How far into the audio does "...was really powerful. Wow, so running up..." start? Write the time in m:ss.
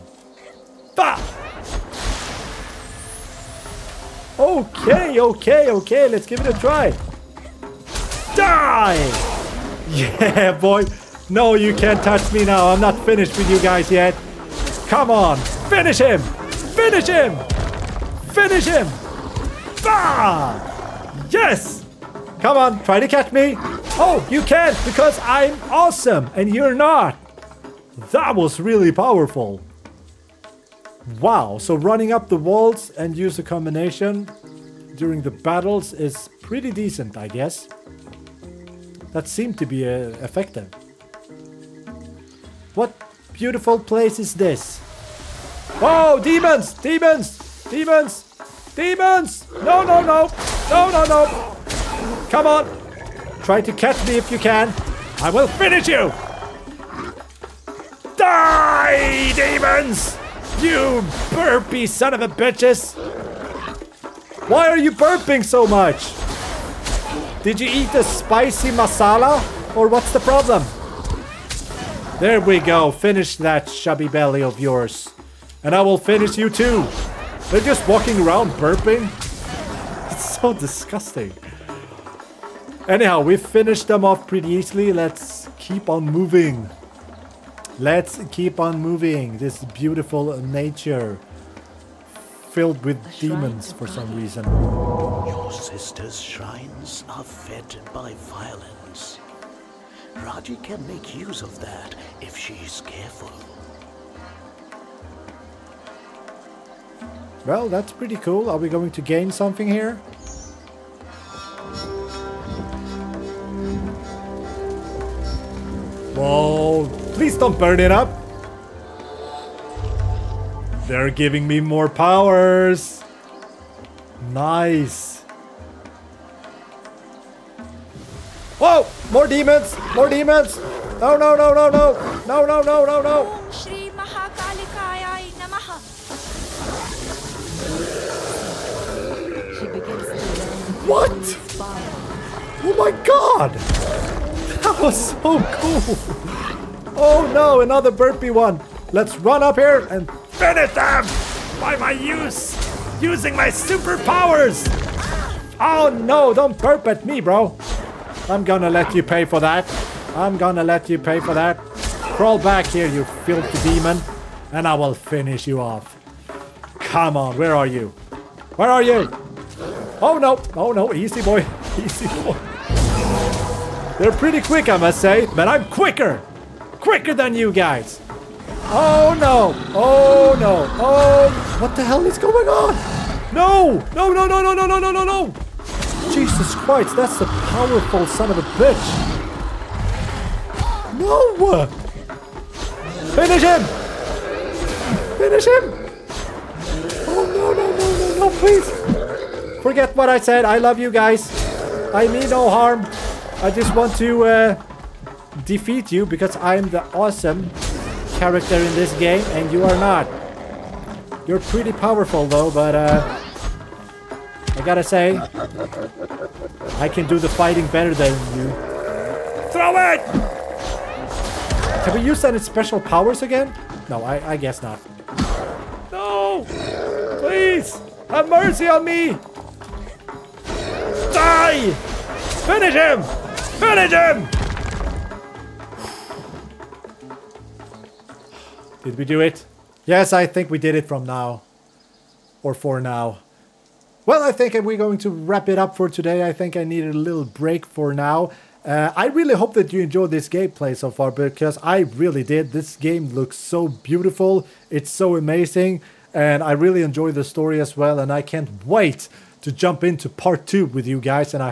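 0:28.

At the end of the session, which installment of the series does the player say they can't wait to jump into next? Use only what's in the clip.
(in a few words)
part 2.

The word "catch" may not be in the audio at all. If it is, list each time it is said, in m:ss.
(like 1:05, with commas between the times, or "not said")
0:23, 0:53.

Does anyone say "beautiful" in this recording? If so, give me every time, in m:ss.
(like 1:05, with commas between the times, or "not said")
0:43, 1:29, 4:13.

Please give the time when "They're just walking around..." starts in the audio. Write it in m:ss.
1:17.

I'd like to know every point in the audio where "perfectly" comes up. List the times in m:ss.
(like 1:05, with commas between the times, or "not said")
not said.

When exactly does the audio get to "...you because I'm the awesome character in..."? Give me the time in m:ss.
3:25.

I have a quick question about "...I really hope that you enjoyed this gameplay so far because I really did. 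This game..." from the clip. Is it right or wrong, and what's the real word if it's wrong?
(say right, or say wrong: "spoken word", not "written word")
right.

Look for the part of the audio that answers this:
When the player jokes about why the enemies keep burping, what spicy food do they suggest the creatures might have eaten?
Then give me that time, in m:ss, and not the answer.
1:08.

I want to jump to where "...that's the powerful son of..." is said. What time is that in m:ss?
3:06.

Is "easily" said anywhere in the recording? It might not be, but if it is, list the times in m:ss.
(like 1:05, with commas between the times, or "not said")
1:24.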